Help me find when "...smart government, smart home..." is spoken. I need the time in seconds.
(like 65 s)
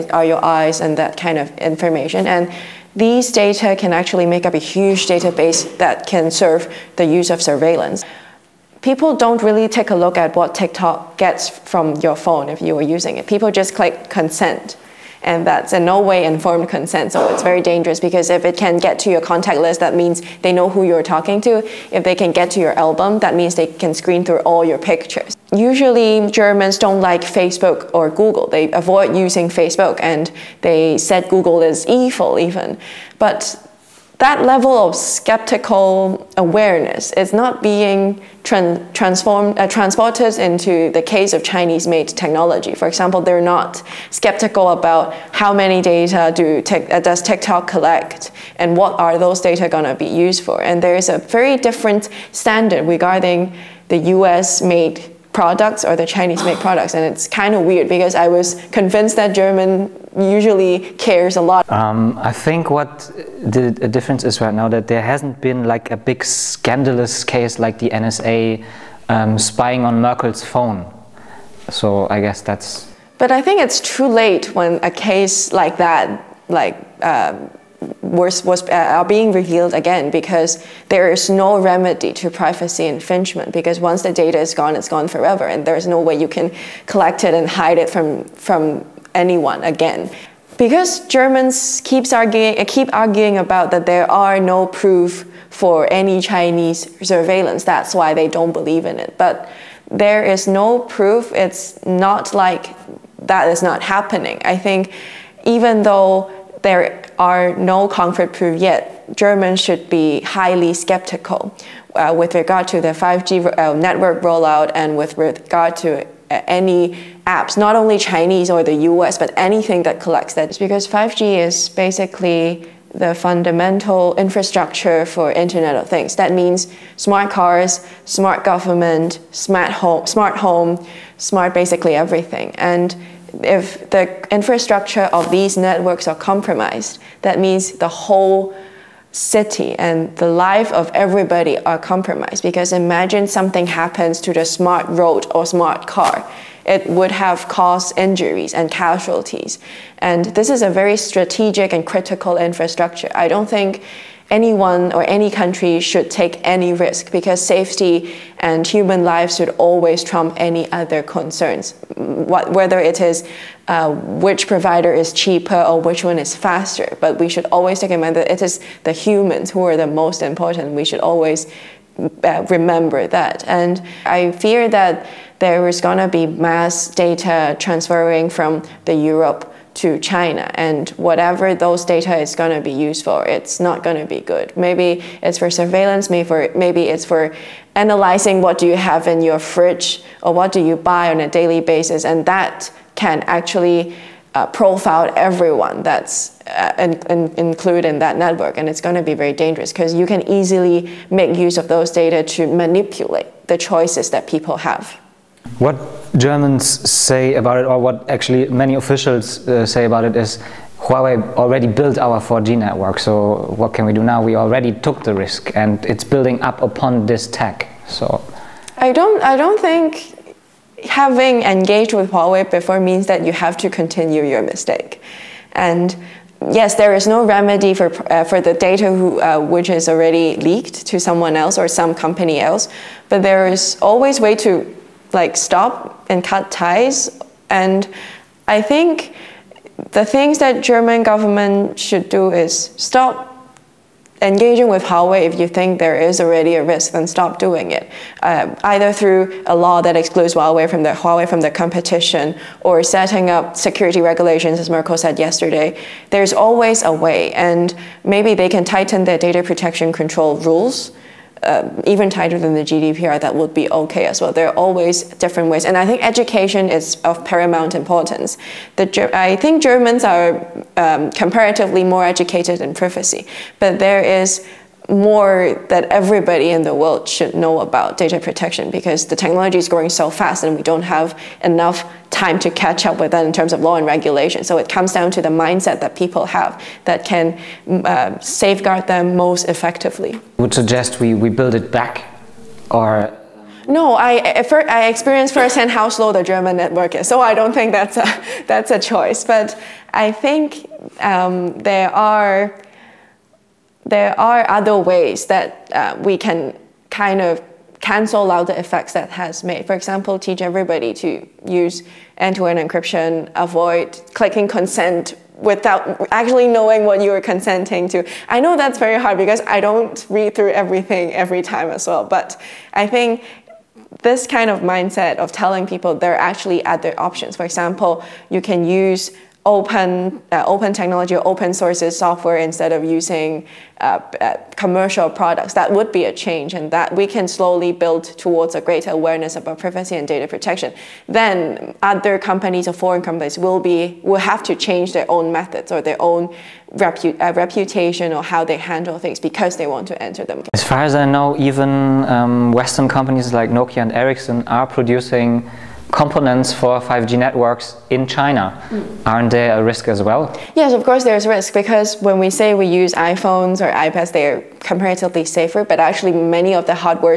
128 s.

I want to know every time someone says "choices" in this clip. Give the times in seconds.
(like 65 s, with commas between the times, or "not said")
203 s, 298 s.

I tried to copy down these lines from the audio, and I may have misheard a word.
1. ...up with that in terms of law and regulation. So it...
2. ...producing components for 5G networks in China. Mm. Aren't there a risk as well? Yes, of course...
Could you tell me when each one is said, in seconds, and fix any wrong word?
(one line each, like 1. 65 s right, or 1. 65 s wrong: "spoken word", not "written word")
1. 282 s right
2. 354 s right.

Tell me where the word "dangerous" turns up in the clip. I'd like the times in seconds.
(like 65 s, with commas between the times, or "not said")
17 s, 199 s.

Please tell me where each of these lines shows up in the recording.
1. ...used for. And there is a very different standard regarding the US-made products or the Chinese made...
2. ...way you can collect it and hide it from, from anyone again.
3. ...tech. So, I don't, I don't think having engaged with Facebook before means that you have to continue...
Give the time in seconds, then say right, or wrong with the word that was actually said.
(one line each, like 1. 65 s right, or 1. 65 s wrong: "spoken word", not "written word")
1. 50 s right
2. 85 s right
3. 217 s wrong: "Huawei", not "Facebook".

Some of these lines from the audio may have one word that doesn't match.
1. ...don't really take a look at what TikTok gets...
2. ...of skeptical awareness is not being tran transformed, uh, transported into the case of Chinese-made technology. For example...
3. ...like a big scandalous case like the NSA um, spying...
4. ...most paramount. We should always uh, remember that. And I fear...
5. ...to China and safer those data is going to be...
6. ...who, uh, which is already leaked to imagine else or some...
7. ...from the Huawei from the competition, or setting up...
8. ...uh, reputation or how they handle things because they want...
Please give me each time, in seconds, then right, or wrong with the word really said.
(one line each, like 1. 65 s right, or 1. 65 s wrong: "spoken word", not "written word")
1. 9 s right
2. 34 s right
3. 65 s right
4. 169 s wrong: "important", not "paramount"
5. 179 s wrong: "whatever", not "safer"
6. 228 s wrong: "someone", not "imagine"
7. 250 s right
8. 347 s right.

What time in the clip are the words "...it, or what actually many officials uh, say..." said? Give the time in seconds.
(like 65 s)
207 s.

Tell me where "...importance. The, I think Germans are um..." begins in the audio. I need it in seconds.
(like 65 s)
267 s.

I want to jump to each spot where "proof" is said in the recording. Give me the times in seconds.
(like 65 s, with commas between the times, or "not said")
94 s, 100 s, 108 s.